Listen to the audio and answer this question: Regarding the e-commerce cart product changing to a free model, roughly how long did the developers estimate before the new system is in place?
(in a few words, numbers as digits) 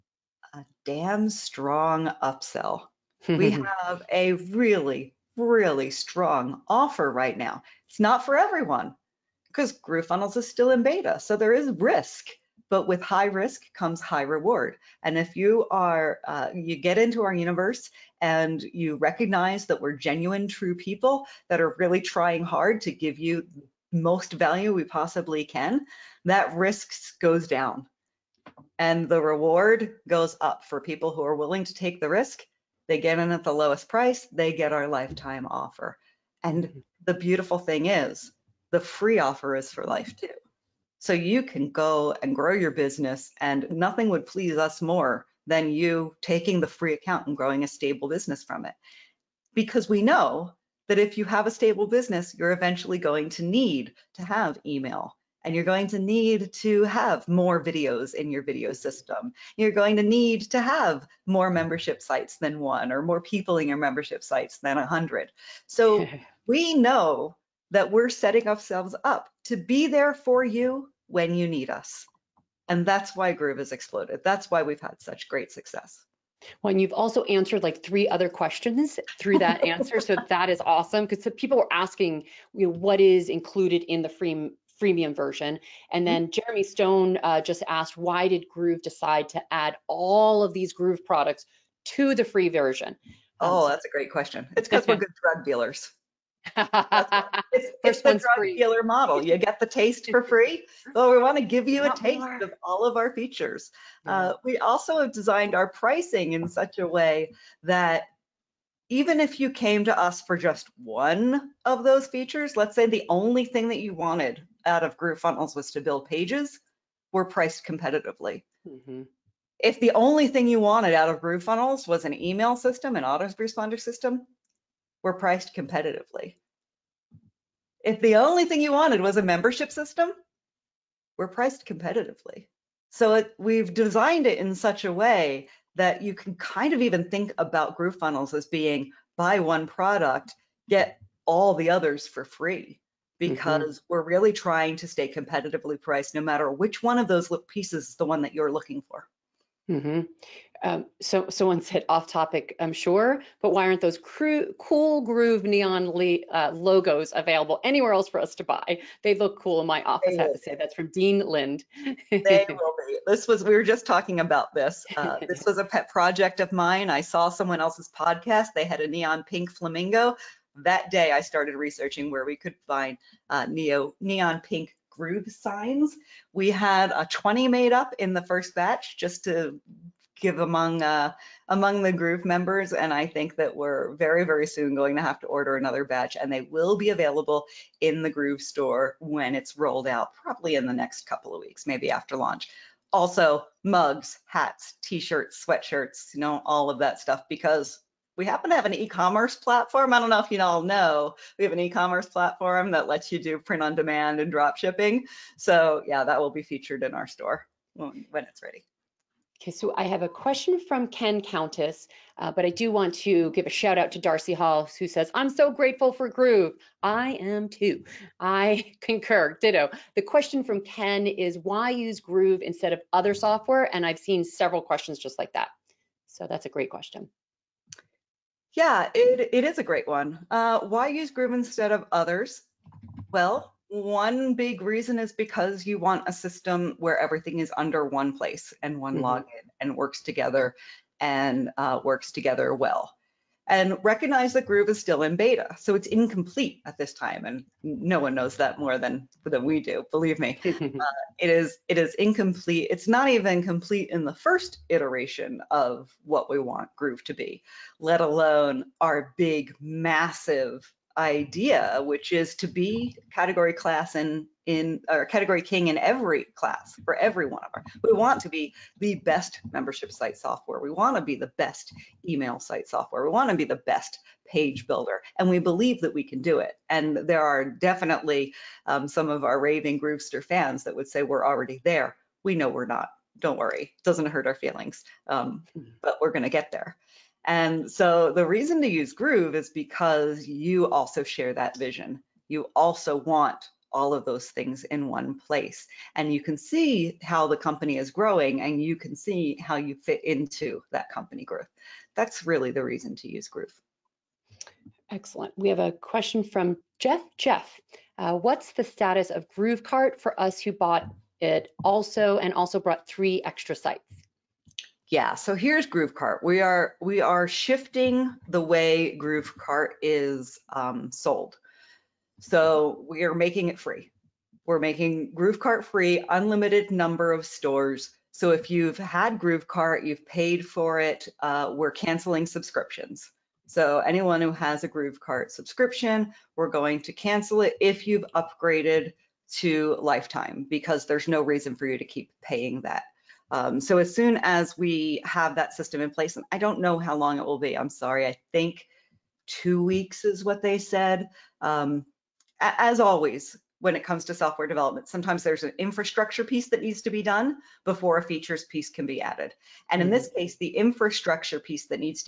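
Two weeks.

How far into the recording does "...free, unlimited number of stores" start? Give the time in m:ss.
5:25.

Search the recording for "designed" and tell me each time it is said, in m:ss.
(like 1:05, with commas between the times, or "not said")
1:45, 2:13.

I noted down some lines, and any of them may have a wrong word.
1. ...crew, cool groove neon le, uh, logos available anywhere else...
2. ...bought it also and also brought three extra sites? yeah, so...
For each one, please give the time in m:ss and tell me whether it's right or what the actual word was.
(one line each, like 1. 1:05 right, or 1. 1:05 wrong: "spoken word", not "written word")
1. 2:33 right
2. 5:10 right.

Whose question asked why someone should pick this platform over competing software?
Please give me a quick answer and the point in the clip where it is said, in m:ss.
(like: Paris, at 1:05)
Ken Countess, at 3:30.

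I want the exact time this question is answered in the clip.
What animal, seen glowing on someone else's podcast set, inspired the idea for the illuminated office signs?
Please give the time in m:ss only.
2:49.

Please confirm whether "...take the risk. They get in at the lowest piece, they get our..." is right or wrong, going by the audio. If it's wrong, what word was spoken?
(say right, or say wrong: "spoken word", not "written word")
wrong: "price", not "piece".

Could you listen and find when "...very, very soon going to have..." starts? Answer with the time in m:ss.
3:03.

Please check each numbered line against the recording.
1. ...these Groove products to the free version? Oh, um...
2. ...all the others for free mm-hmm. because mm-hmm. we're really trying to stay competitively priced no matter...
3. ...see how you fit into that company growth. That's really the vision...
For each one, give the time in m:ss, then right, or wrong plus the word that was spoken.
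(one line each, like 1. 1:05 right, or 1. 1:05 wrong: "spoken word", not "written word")
1. 1:30 right
2. 2:21 right
3. 4:58 wrong: "reason", not "vision".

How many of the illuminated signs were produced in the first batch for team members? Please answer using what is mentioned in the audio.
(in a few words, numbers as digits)
20.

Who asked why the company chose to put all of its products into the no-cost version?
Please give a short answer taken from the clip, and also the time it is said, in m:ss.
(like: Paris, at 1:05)
Jeremy Stone, at 1:26.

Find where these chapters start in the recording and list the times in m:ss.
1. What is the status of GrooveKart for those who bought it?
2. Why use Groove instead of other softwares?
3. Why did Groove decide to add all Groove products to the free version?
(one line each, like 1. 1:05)
1. 5:04
2. 3:39
3. 1:22.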